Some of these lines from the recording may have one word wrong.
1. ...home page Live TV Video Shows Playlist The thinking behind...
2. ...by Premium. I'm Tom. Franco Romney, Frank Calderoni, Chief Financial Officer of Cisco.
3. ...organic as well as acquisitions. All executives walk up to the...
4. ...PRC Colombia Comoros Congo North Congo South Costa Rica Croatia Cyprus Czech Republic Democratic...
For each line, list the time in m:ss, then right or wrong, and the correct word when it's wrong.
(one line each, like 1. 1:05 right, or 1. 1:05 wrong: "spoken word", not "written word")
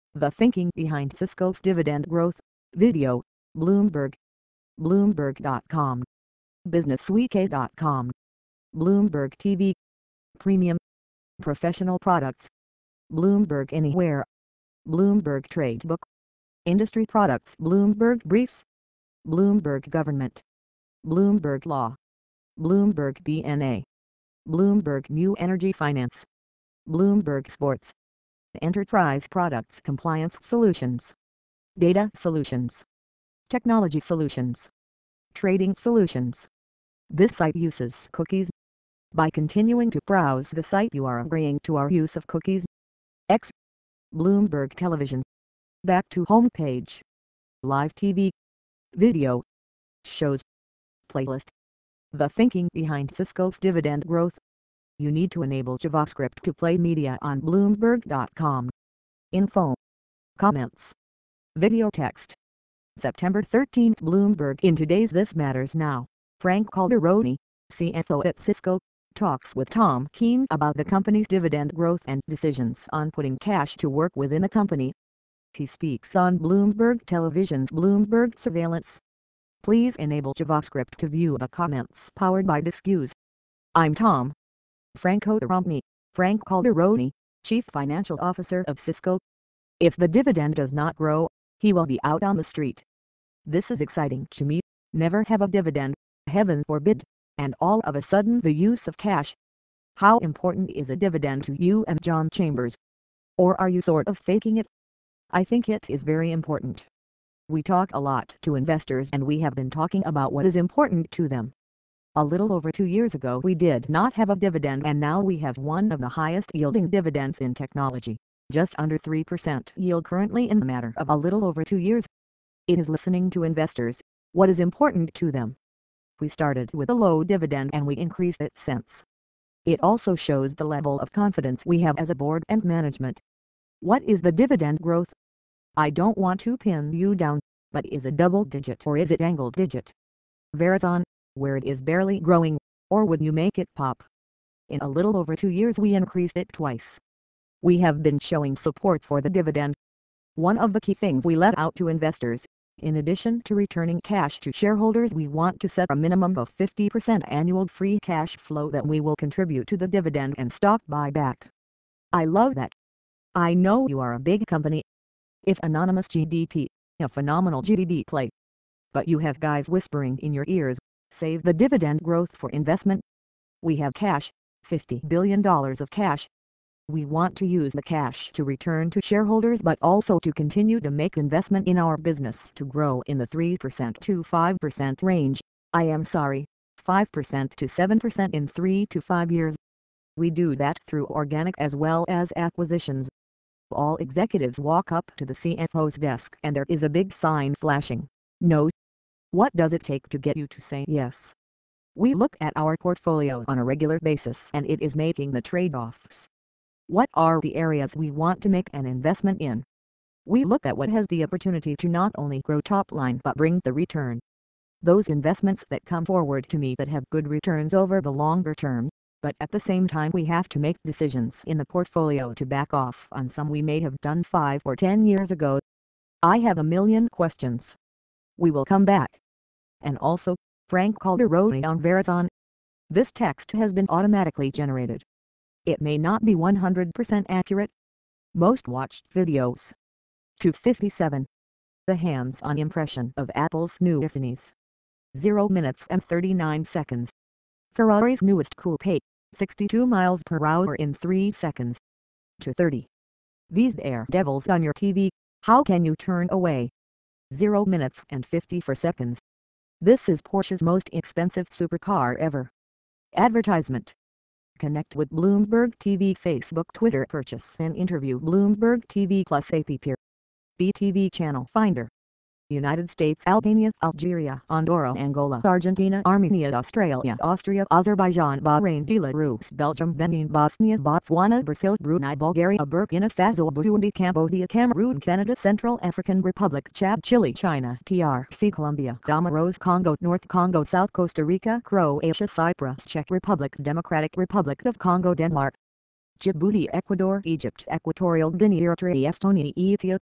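1. 0:46 right
2. 1:22 wrong: "Disqus", not "Premium"
3. 3:11 right
4. 4:47 right.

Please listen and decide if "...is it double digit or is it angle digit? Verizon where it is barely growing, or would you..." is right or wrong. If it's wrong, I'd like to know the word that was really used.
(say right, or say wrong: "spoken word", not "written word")
right.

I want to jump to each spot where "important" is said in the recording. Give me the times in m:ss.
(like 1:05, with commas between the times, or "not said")
1:40, 1:46, 1:50, 2:04.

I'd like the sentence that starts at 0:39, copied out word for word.
By continuing to browse the site you are agreeing to our use of cookies.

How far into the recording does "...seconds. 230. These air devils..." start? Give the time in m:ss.
4:11.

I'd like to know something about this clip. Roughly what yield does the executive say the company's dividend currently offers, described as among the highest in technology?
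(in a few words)
just under 3%.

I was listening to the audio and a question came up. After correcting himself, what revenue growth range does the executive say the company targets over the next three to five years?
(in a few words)
5% to 7%.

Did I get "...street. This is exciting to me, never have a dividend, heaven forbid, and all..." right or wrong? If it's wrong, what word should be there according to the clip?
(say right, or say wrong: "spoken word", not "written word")
right.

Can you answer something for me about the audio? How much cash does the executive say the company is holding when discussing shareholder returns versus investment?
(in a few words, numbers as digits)
$50 billion.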